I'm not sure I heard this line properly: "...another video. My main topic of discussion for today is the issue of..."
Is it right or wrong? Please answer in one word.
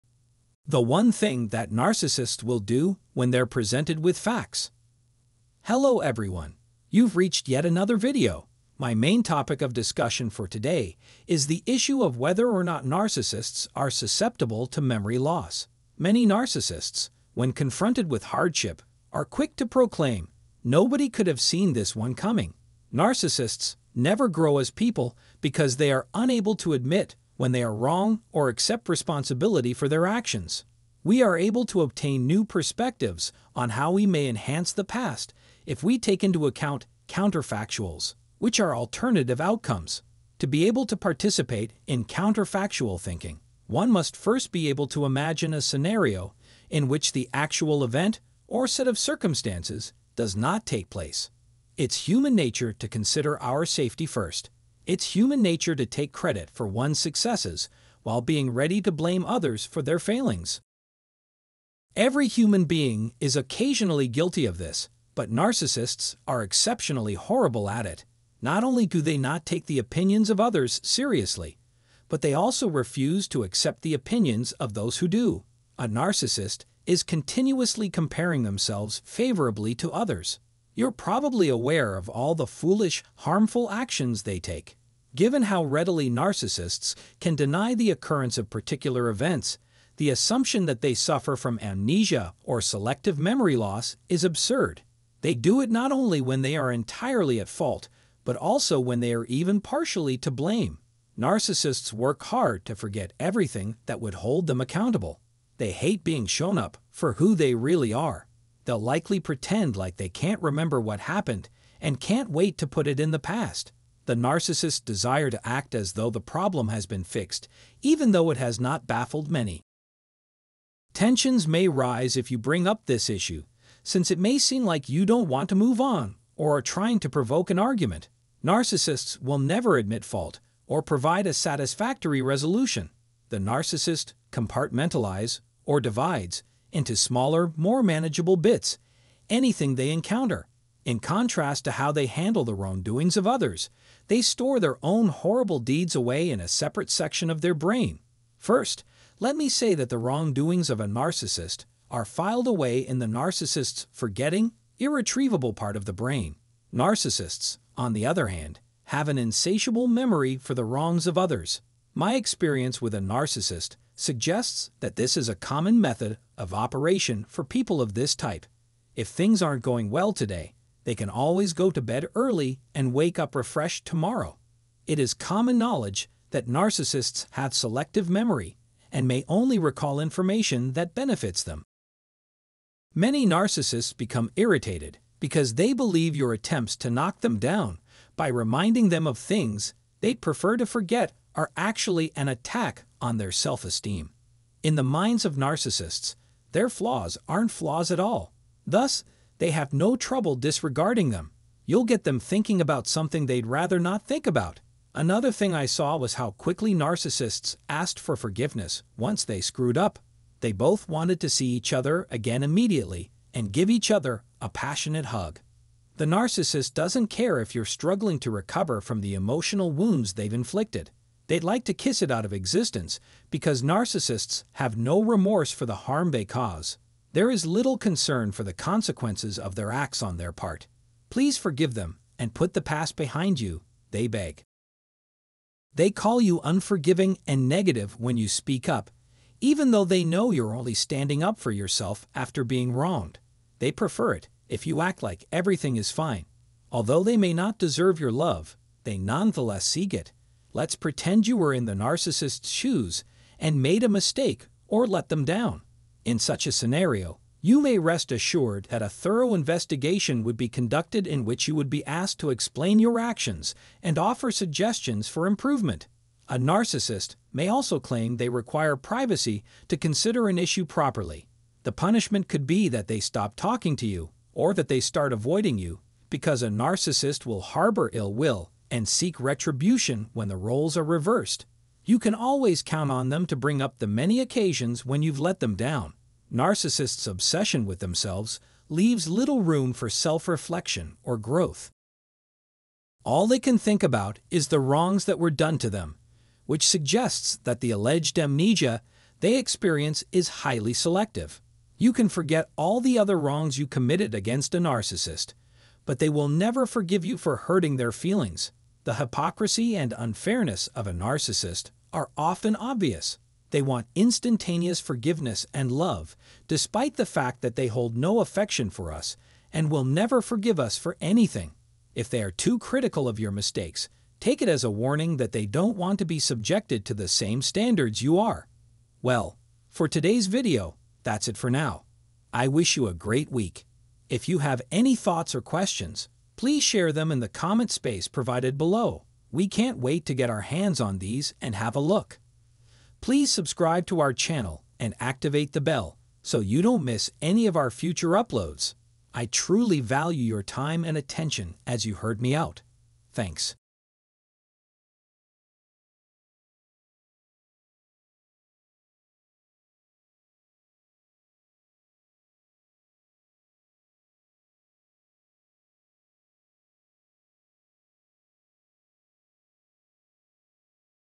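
right.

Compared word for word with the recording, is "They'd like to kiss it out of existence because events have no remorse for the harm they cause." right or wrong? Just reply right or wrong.
wrong.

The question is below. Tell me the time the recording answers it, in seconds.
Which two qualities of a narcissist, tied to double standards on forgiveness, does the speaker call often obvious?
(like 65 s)
308 s.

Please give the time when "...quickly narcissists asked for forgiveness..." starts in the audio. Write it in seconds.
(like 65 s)
206 s.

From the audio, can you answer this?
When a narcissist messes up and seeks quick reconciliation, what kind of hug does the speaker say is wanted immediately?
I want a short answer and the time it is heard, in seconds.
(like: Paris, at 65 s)
A passionate hug, at 214 s.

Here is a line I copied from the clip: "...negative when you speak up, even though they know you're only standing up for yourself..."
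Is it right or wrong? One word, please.
right.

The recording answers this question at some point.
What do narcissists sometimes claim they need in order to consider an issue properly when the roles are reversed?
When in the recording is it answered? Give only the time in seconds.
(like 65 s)
268 s.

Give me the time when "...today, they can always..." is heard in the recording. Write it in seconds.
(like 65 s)
170 s.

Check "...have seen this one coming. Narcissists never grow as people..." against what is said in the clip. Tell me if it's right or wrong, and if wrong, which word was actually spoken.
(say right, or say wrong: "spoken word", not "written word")
right.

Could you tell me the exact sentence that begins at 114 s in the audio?
The narcissist's desire to act as though the problem has been fixed, even though it has not baffled many.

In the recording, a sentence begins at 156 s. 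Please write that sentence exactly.
Narcissists, on the other hand, have an insatiable memory for the wrongs of others.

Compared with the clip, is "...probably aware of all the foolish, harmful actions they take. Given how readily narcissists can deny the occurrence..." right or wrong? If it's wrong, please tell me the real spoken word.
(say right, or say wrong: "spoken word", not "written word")
right.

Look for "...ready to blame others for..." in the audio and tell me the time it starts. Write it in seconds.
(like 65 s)
58 s.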